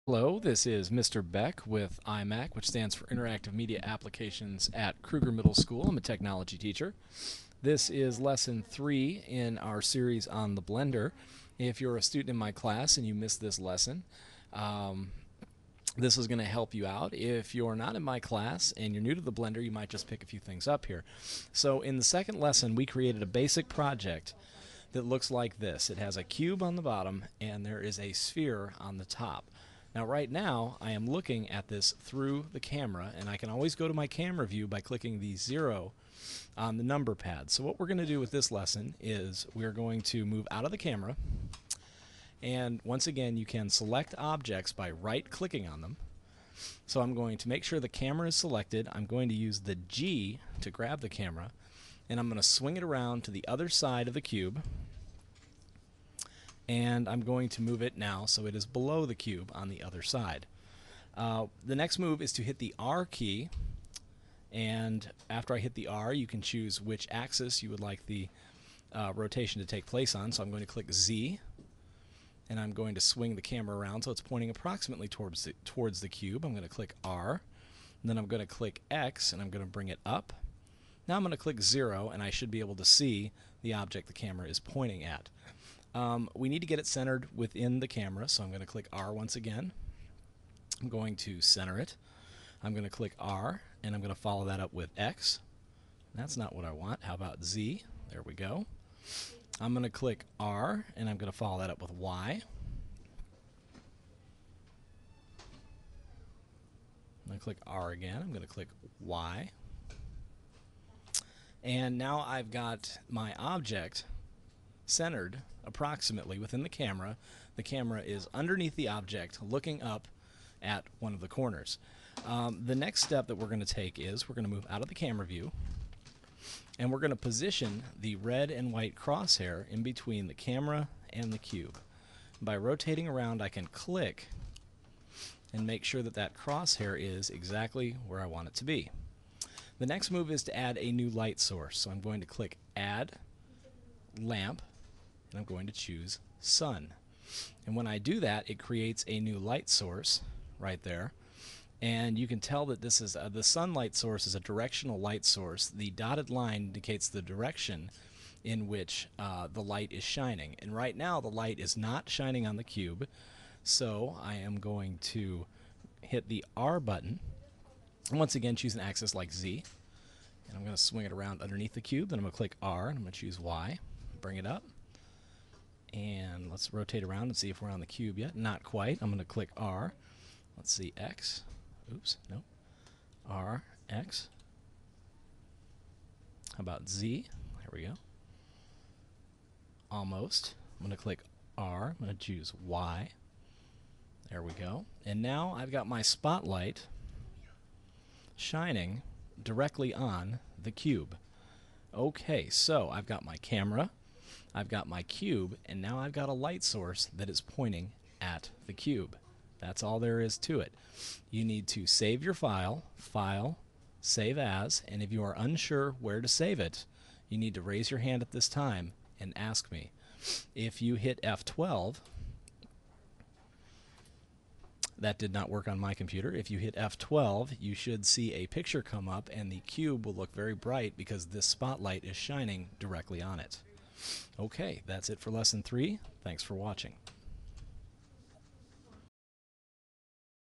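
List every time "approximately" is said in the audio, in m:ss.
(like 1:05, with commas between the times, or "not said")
1:14, 1:55.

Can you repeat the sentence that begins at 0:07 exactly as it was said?
This is lesson three in our series on the Blender.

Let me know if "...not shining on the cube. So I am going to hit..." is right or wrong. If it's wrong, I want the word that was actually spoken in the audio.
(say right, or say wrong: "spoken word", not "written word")
right.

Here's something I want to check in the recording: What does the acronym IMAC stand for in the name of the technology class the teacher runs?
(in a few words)
Interactive Media Applications.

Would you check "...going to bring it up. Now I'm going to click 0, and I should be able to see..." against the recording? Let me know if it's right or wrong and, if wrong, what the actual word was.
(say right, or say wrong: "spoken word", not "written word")
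right.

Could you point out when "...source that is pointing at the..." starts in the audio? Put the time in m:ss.
3:26.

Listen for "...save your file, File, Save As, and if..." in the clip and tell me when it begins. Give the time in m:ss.
3:31.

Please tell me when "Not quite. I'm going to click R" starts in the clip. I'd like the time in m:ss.
2:58.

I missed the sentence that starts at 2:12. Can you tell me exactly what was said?
By rotating around I can click and make sure that that crosshair is exactly where I want it to be.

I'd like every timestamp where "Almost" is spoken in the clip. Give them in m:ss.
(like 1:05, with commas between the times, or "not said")
3:09.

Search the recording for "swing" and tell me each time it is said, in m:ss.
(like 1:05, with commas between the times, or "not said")
0:52, 1:13, 2:50.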